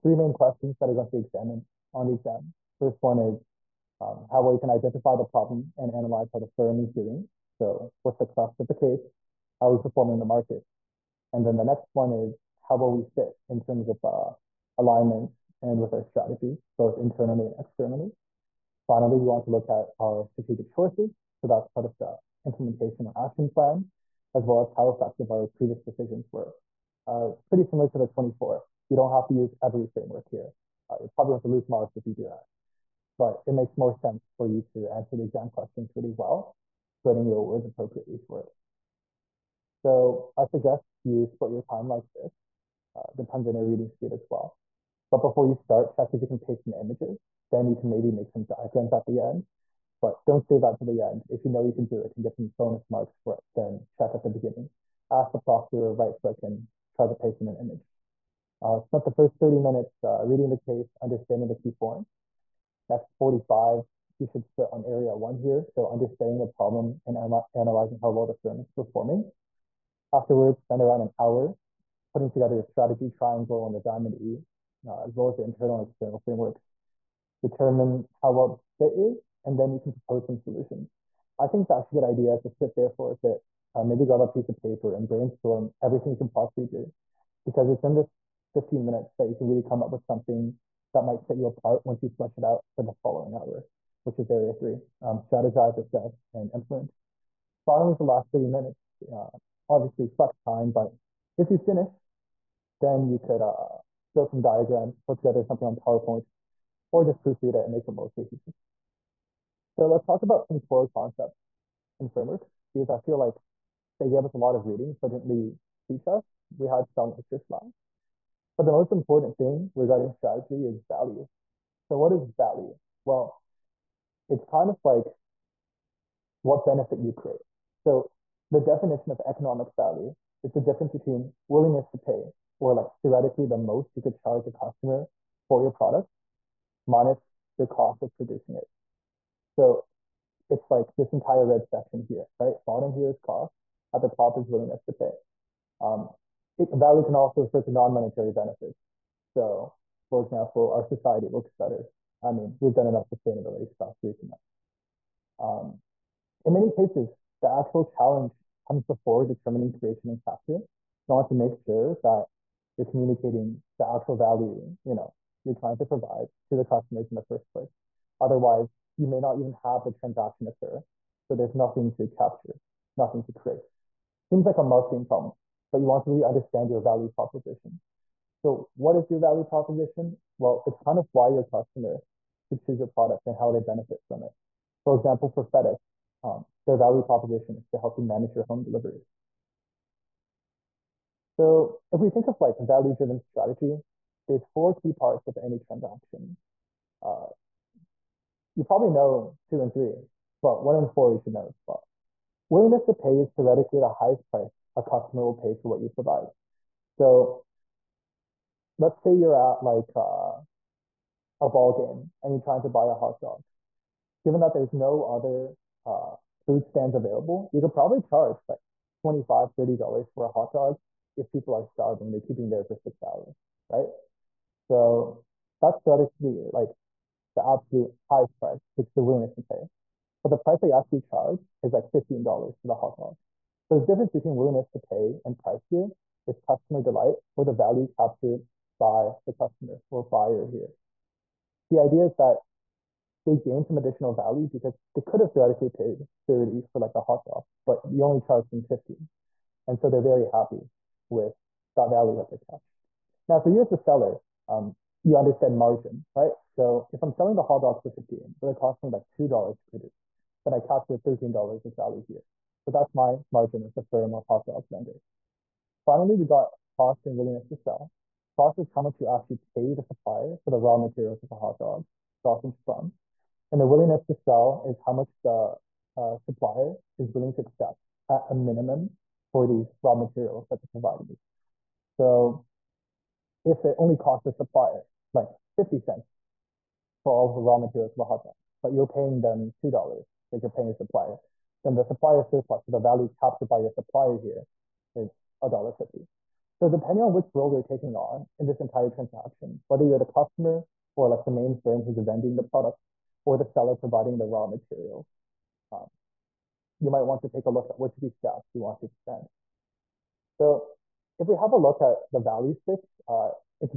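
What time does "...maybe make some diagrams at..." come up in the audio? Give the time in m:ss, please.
0:47.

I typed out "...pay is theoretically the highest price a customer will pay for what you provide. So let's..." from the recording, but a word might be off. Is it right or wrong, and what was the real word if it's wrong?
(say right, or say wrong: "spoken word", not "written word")
right.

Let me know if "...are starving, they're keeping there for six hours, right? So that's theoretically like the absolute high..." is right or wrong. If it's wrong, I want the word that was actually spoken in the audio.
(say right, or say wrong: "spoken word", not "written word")
right.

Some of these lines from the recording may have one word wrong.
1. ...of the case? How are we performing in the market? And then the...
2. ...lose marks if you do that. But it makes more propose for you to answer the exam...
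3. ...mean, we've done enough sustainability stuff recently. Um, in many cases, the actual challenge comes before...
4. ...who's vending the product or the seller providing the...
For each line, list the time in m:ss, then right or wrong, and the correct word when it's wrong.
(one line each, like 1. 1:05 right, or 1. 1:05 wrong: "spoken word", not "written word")
1. 0:08 right
2. 0:31 wrong: "sense", not "propose"
3. 2:32 right
4. 5:01 right.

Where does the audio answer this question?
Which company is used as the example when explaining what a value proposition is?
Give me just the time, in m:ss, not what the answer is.
3:05.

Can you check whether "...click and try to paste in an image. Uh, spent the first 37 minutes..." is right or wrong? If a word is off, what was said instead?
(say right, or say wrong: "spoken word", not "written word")
wrong: "30", not "37".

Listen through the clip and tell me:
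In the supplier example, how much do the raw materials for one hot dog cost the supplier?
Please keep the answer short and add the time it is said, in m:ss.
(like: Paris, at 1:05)
50 cents, at 4:45.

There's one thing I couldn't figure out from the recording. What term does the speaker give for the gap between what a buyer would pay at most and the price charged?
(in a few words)
customer delight.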